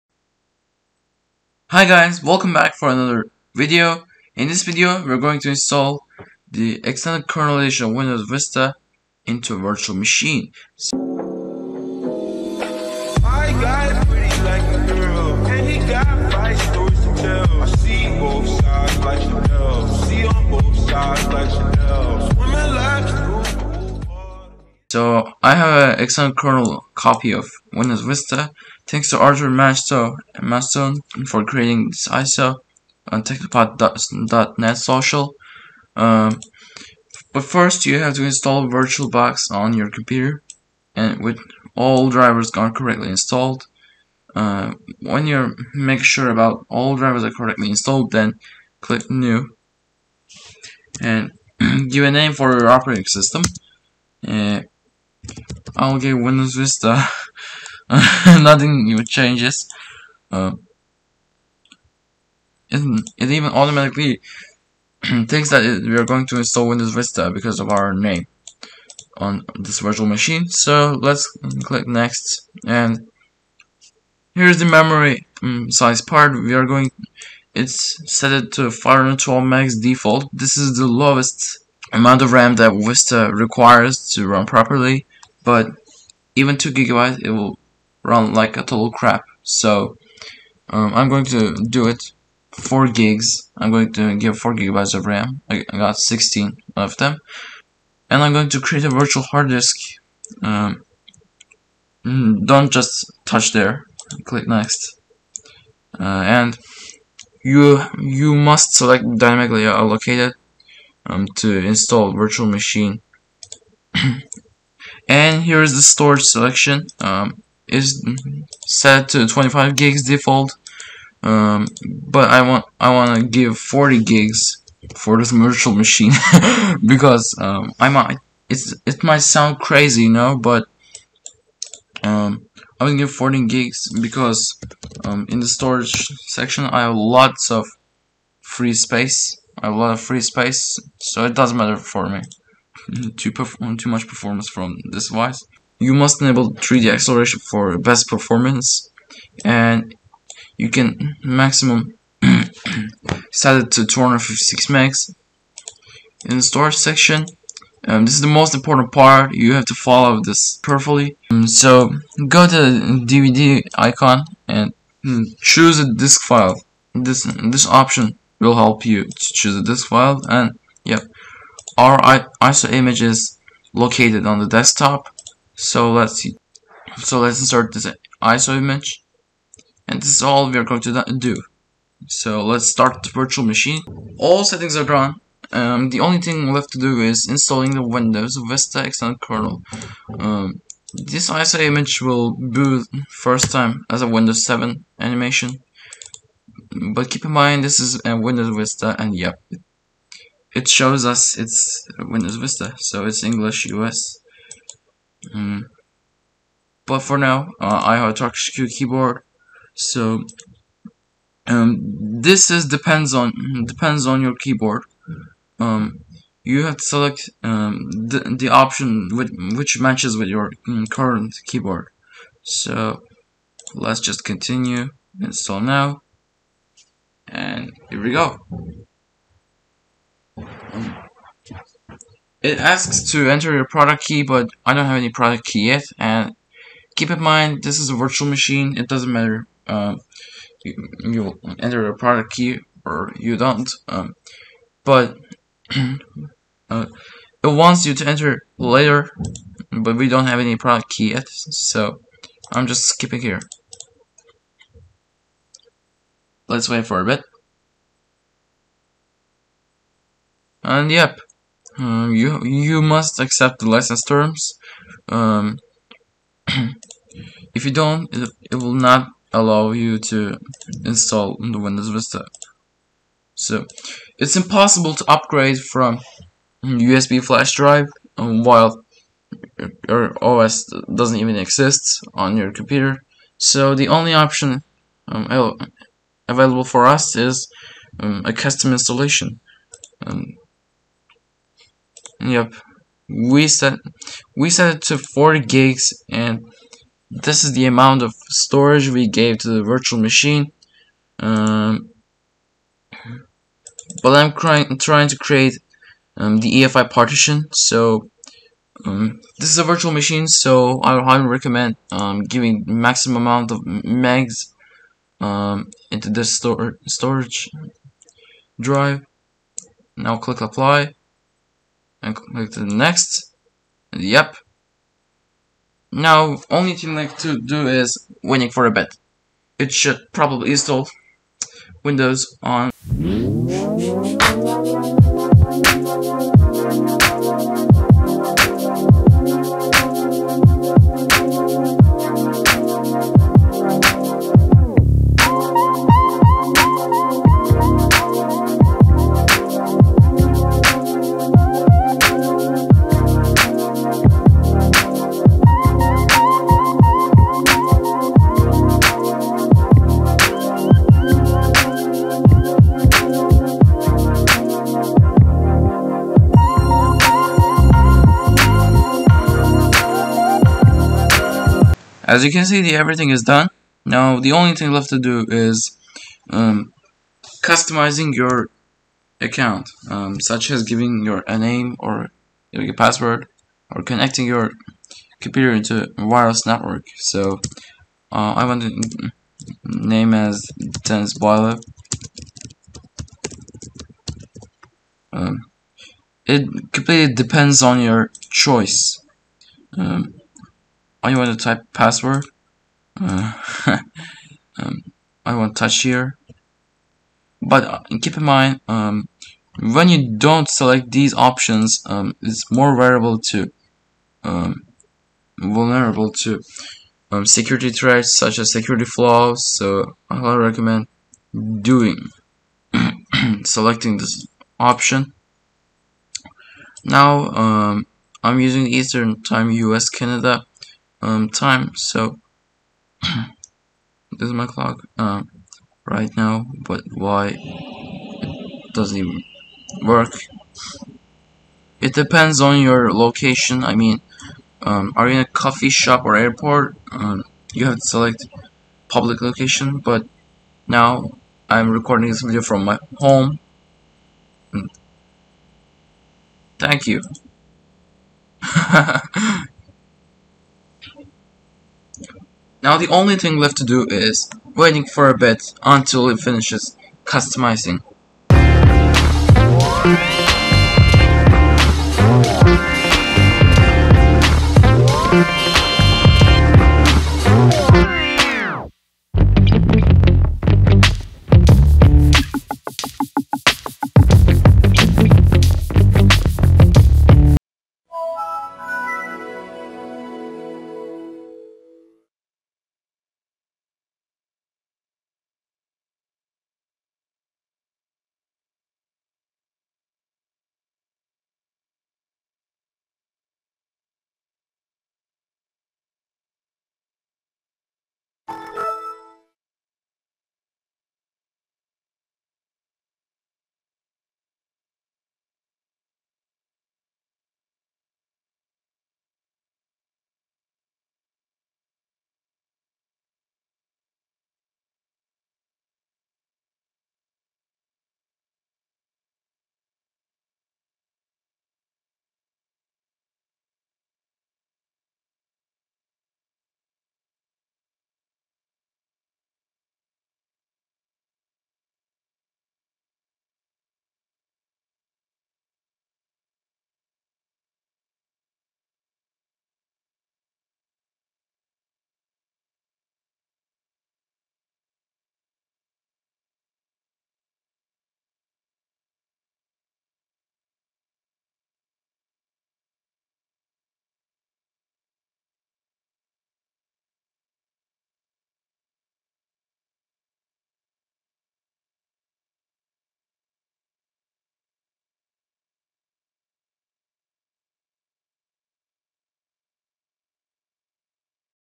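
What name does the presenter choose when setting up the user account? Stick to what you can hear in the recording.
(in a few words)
Tennis Boiler.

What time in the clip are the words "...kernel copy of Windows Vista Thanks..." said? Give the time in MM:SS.
00:26.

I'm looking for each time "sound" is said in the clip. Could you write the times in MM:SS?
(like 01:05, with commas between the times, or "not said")
02:09.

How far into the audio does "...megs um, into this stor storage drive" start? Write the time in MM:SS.
05:13.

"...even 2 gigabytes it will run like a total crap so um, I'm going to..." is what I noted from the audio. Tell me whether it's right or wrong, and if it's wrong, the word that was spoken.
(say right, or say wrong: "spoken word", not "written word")
right.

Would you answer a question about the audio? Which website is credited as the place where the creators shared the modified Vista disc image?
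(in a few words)
technopod.net.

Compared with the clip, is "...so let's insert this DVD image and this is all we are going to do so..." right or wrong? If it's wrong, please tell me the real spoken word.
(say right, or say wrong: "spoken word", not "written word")
wrong: "ISO", not "DVD".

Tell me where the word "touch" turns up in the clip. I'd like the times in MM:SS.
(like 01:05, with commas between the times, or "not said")
01:43, 06:45.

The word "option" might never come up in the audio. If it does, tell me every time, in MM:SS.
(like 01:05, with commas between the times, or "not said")
02:47, 03:38, 04:44, 06:51, 07:04.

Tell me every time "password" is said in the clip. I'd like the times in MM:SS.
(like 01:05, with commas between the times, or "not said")
06:22, 06:41.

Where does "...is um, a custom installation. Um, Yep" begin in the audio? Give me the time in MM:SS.
04:47.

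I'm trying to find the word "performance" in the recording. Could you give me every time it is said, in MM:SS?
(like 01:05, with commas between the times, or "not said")
02:24, 02:28.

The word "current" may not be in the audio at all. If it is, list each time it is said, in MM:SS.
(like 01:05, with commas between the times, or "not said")
03:40.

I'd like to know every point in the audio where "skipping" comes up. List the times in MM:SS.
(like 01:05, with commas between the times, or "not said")
04:12.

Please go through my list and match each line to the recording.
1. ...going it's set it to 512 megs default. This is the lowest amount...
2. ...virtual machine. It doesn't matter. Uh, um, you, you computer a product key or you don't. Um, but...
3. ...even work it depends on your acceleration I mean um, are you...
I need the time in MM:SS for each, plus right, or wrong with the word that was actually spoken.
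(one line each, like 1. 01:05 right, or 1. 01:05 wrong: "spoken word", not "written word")
1. 01:16 right
2. 03:57 wrong: "enter", not "computer"
3. 07:18 wrong: "location", not "acceleration".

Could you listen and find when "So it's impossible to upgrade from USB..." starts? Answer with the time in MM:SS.
04:33.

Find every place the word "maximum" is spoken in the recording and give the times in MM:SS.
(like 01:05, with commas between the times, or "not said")
02:31, 05:12.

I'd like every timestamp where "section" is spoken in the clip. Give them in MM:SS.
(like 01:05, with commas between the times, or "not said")
02:16, 02:36.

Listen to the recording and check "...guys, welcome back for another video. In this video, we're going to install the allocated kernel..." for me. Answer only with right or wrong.
wrong.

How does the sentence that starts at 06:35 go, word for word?
Um, it completely depends on your choice.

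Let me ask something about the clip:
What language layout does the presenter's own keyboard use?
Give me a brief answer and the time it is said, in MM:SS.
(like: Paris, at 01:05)
Turkish, at 03:28.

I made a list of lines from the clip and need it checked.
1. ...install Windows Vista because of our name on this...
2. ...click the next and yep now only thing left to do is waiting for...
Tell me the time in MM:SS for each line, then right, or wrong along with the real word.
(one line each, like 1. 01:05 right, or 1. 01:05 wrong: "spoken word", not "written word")
1. 01:06 right
2. 05:22 right.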